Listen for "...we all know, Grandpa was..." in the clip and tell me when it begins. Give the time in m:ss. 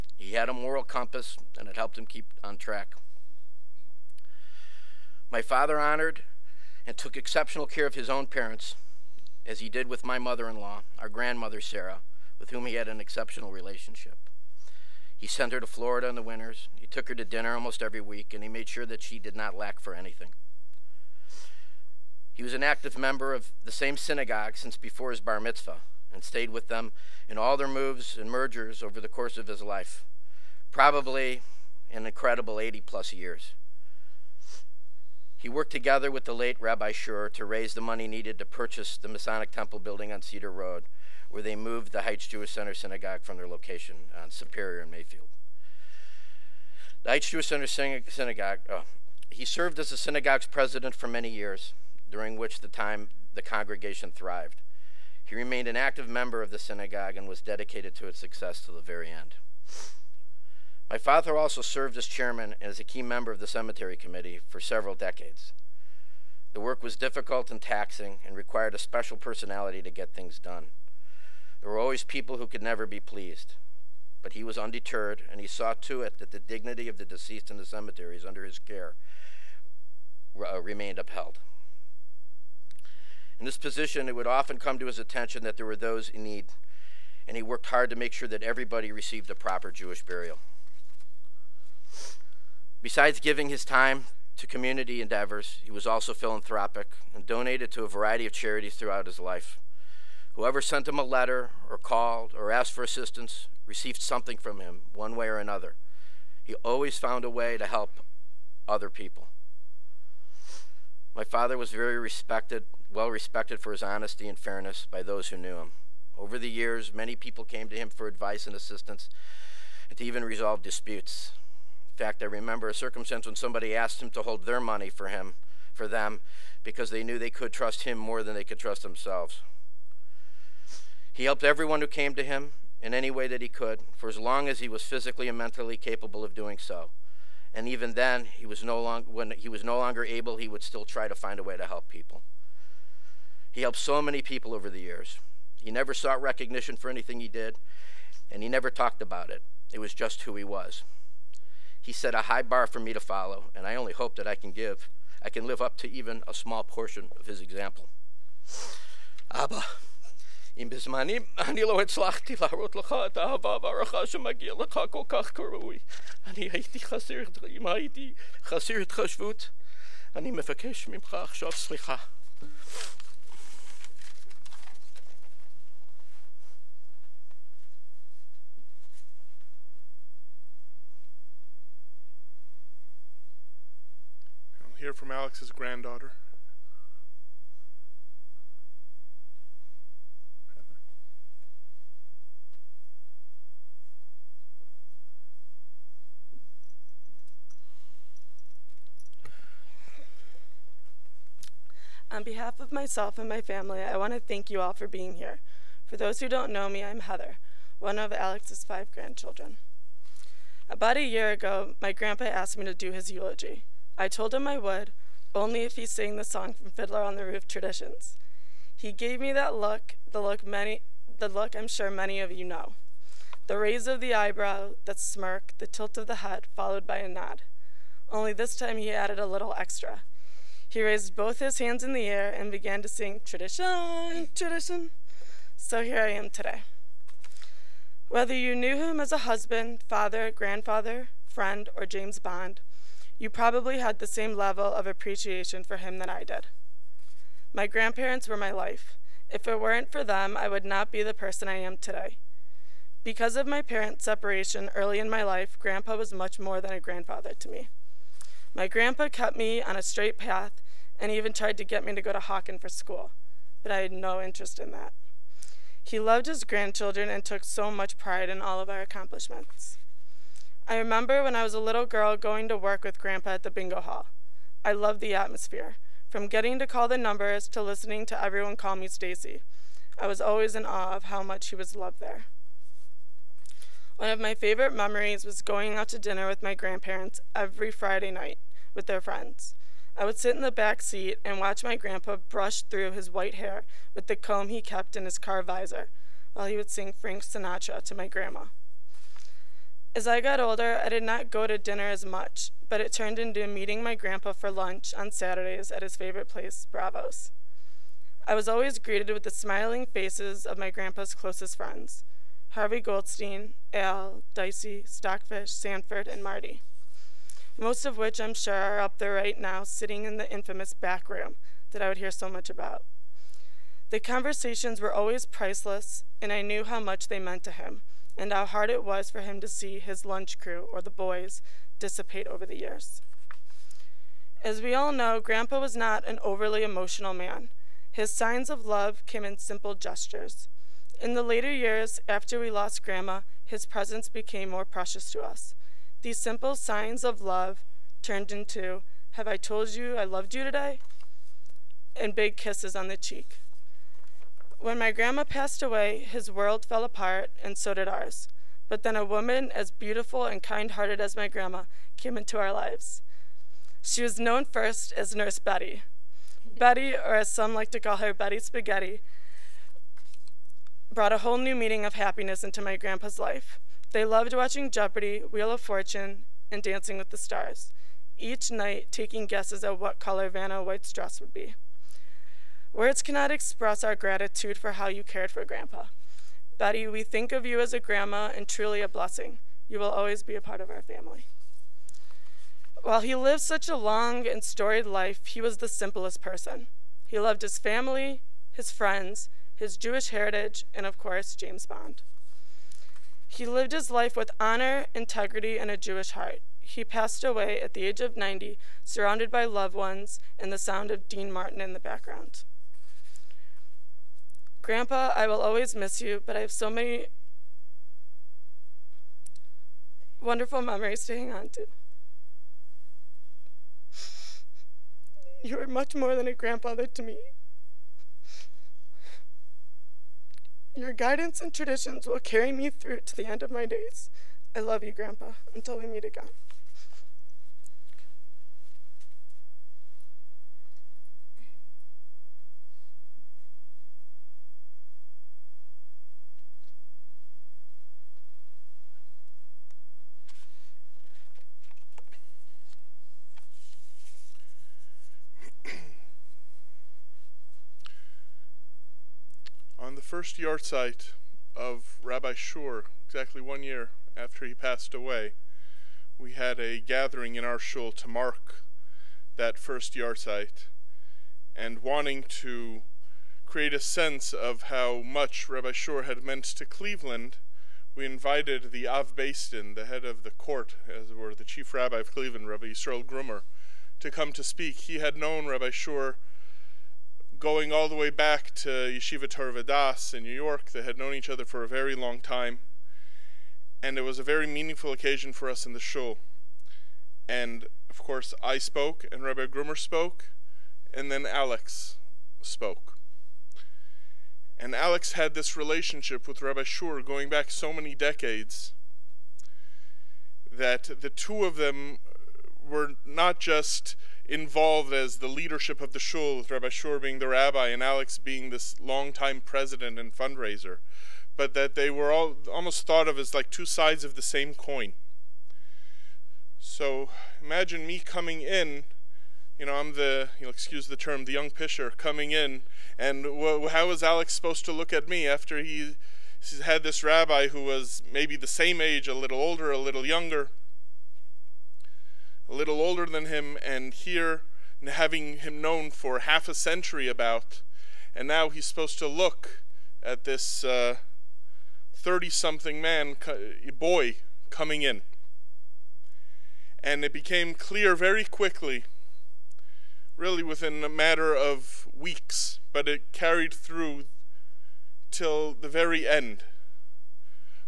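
5:34.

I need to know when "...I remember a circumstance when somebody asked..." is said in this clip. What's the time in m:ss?
2:02.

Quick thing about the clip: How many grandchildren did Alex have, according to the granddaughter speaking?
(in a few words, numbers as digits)
5.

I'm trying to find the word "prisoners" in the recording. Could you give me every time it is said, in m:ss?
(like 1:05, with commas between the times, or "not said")
not said.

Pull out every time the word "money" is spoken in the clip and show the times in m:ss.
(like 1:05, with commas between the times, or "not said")
0:37, 2:04.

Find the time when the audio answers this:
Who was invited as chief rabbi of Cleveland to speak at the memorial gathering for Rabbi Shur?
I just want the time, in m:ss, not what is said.
8:02.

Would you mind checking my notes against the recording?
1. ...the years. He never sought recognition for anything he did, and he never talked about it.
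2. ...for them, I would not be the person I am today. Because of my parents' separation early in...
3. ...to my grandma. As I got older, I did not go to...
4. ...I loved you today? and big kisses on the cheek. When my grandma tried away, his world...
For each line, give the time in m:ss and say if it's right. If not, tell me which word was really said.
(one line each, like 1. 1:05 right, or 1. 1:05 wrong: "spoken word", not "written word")
1. 2:24 right
2. 4:09 right
3. 4:57 right
4. 5:49 wrong: "passed", not "tried".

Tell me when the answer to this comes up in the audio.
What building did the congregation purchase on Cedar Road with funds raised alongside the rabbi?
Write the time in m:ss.
0:39.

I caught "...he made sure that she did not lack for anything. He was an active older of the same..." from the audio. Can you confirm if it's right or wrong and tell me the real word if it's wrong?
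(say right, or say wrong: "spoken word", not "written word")
wrong: "member", not "older".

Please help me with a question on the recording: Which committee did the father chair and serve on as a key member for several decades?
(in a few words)
cemetery committee.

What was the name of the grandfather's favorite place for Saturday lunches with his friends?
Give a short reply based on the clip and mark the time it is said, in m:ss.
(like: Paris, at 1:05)
Bravo's, at 5:06.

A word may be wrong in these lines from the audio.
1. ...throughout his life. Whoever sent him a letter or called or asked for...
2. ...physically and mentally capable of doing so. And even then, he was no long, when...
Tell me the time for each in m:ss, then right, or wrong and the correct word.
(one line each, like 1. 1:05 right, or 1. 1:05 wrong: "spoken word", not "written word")
1. 1:38 right
2. 2:14 right.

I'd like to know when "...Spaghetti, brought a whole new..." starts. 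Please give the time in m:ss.
6:08.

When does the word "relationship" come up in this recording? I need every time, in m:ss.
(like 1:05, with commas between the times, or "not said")
0:13, 8:25.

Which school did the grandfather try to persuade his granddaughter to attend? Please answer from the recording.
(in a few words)
Hawken.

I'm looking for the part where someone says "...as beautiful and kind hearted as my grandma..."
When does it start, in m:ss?
5:59.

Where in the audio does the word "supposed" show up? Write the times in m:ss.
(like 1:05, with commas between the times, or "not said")
8:54, 9:08.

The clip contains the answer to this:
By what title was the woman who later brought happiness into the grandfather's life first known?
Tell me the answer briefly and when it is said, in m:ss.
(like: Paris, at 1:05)
Nurse Betty, at 6:05.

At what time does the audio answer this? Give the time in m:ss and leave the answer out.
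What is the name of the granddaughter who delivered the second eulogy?
3:27.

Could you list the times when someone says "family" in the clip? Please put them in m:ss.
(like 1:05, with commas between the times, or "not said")
3:23, 6:30, 6:37.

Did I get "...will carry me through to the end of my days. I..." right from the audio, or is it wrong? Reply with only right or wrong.
right.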